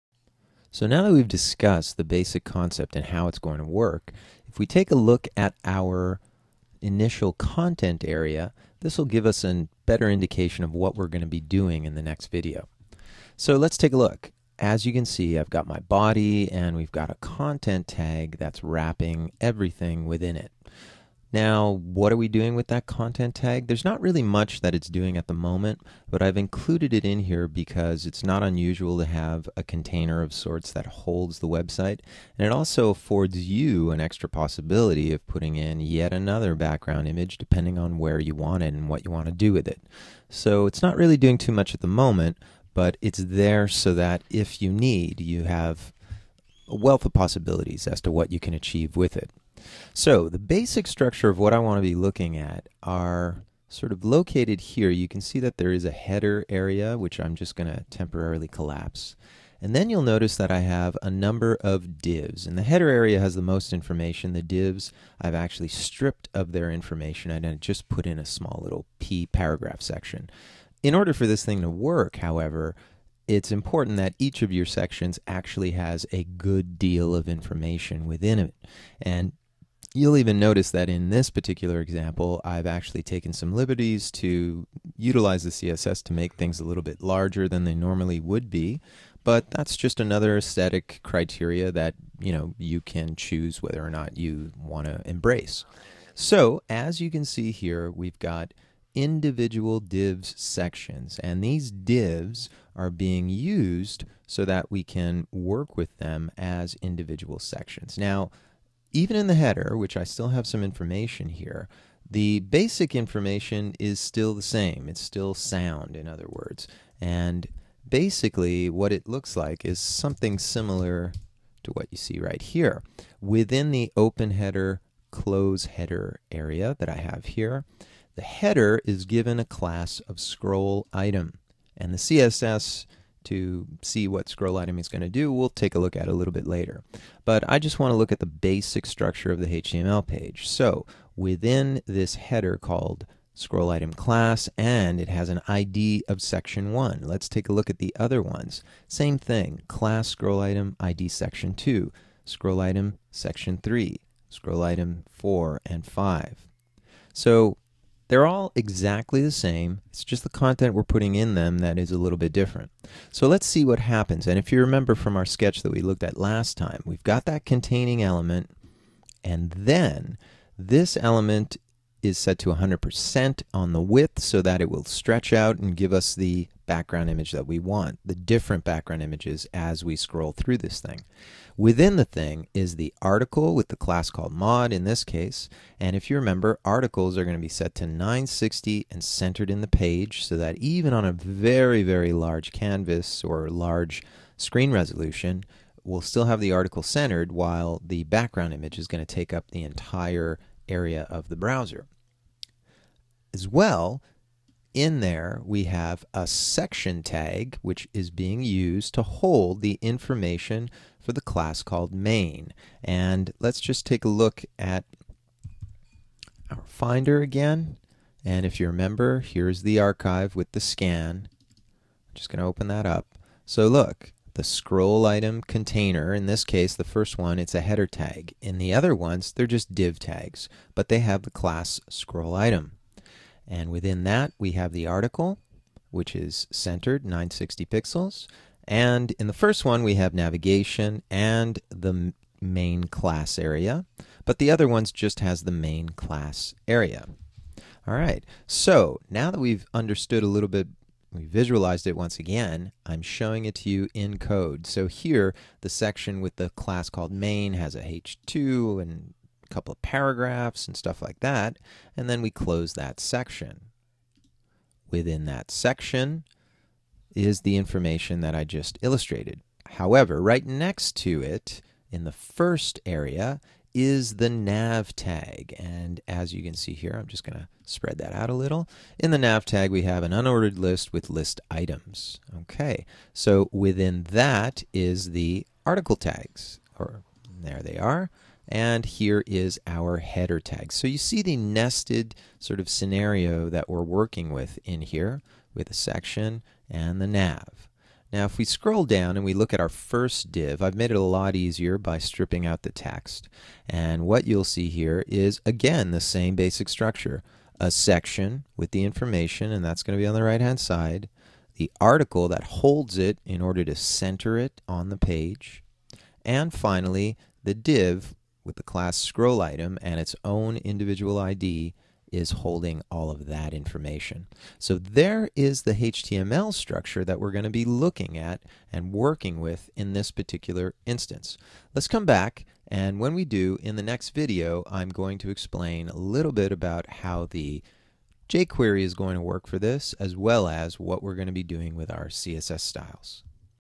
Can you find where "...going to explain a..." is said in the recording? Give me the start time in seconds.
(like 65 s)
334 s.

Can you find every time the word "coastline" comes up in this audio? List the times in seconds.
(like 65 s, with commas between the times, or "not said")
not said.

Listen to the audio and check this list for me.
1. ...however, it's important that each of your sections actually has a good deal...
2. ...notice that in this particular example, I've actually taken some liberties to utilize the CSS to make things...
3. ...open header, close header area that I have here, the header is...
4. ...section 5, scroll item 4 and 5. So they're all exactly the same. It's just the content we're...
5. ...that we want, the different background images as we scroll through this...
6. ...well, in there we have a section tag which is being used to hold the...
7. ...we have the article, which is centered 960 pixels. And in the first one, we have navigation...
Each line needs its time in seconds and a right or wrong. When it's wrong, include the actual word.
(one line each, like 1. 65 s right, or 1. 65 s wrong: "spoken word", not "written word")
1. 72 s right
2. 80 s right
3. 123 s right
4. 153 s wrong: "3", not "5"
5. 177 s right
6. 203 s right
7. 234 s right.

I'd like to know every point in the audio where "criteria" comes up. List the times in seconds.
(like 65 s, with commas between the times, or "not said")
91 s.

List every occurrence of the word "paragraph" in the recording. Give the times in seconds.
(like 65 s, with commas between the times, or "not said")
69 s, 259 s.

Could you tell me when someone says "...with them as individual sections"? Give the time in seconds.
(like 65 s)
105 s.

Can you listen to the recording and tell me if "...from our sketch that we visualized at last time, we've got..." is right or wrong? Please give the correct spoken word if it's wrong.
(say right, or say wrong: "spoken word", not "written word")
wrong: "looked", not "visualized".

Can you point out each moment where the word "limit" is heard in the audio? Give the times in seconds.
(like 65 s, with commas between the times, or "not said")
not said.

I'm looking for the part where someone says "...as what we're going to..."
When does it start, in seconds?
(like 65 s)
340 s.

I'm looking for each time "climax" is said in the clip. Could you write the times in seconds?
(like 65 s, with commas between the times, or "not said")
not said.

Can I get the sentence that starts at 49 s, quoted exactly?
So the basic structure of what I want to be looking at are sort of located here.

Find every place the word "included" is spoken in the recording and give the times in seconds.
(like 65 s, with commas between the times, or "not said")
26 s.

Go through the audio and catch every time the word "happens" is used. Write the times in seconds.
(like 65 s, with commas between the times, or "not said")
163 s.